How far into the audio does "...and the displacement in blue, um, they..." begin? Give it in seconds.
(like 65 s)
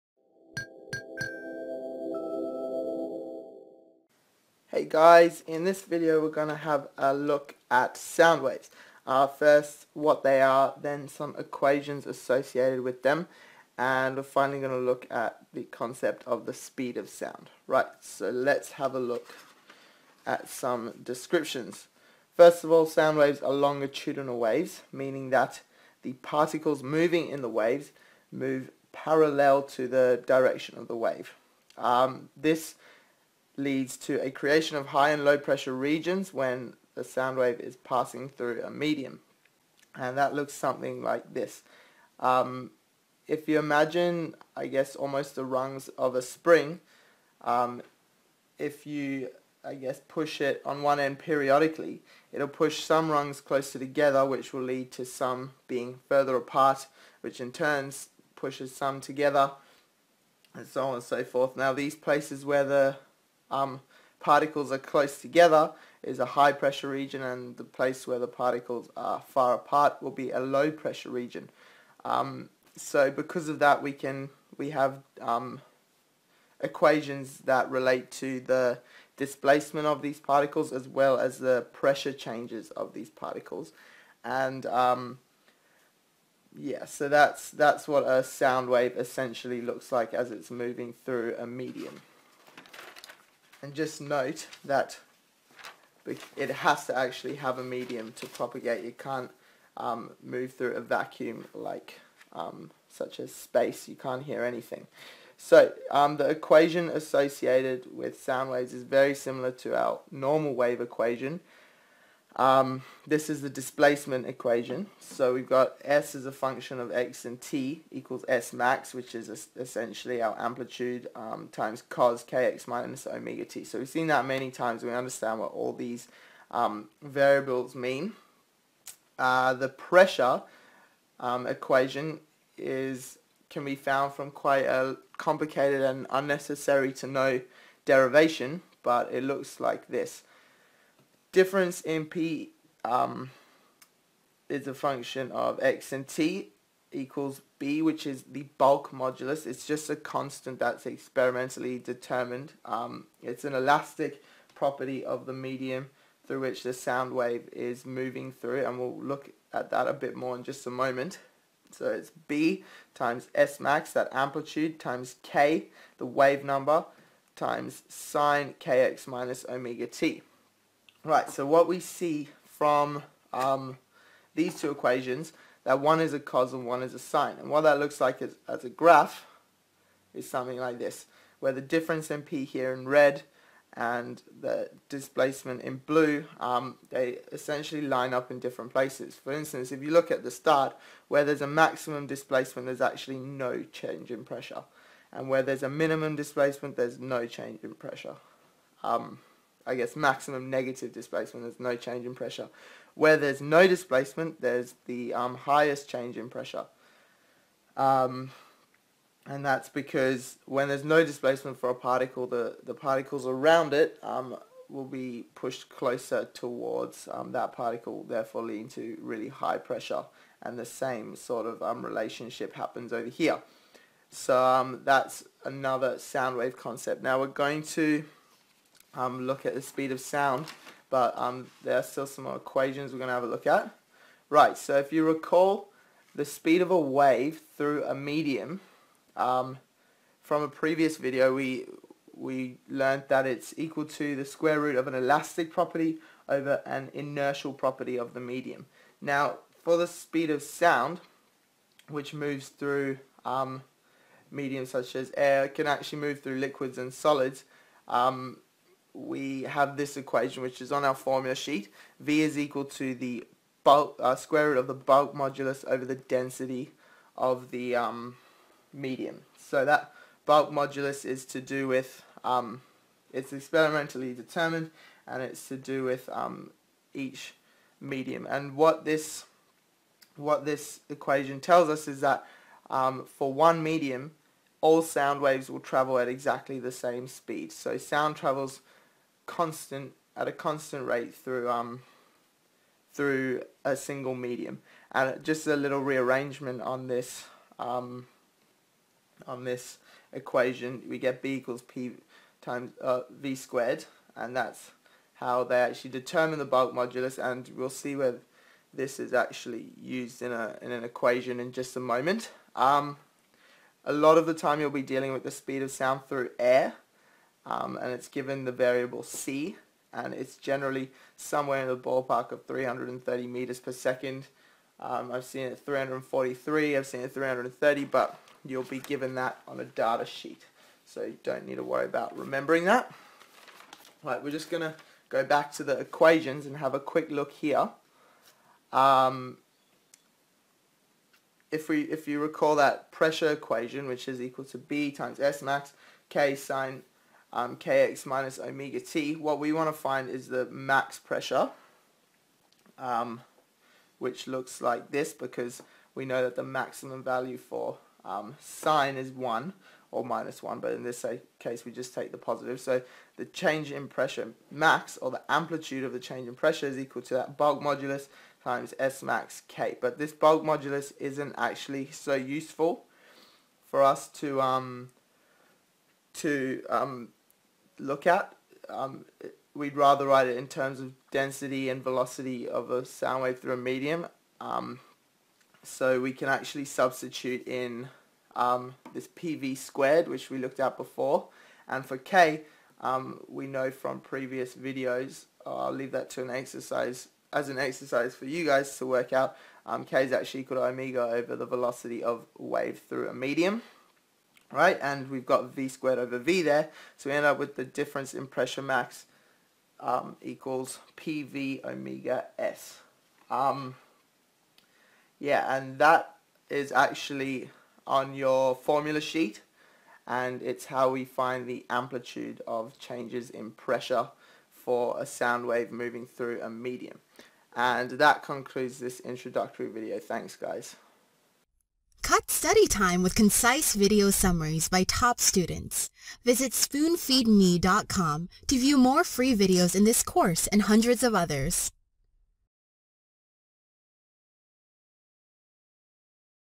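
183 s.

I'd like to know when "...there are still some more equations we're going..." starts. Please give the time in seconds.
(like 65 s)
231 s.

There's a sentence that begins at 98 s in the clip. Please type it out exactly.
You can't um, move through a vacuum like um, such as space.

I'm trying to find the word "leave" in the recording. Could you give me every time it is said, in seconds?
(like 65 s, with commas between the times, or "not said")
395 s.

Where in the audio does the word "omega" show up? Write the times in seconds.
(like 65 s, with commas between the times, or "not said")
123 s, 169 s, 348 s, 400 s, 411 s.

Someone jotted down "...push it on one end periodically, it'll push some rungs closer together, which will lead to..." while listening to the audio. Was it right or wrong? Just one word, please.
right.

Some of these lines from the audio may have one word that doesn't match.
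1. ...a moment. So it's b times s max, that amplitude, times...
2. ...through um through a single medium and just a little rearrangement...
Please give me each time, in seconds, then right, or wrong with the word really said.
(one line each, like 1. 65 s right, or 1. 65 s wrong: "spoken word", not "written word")
1. 160 s right
2. 291 s right.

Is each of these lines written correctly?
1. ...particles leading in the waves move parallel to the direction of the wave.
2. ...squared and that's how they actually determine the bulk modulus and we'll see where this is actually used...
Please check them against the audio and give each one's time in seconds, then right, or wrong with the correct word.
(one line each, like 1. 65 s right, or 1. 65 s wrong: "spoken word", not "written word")
1. 26 s wrong: "moving", not "leading"
2. 303 s right.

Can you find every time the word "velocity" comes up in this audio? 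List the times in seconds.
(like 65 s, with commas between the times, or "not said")
381 s, 401 s.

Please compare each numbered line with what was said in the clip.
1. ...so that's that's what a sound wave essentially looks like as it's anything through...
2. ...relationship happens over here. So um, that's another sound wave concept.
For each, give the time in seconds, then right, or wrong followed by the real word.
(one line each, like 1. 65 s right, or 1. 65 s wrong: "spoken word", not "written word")
1. 86 s wrong: "moving", not "anything"
2. 221 s right.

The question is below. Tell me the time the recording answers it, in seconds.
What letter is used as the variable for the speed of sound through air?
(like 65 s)
319 s.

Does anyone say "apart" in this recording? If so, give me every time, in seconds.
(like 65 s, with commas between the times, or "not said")
56 s, 69 s.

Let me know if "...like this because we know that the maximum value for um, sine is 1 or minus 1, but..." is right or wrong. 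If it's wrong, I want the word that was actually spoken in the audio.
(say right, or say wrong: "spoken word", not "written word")
right.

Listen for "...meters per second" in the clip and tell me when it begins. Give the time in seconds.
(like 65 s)
323 s.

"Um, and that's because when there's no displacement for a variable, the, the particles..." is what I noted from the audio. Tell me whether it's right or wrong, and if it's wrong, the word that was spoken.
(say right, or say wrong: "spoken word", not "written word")
wrong: "particle", not "variable".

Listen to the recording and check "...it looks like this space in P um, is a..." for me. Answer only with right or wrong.
wrong.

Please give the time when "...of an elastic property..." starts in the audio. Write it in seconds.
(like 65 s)
244 s.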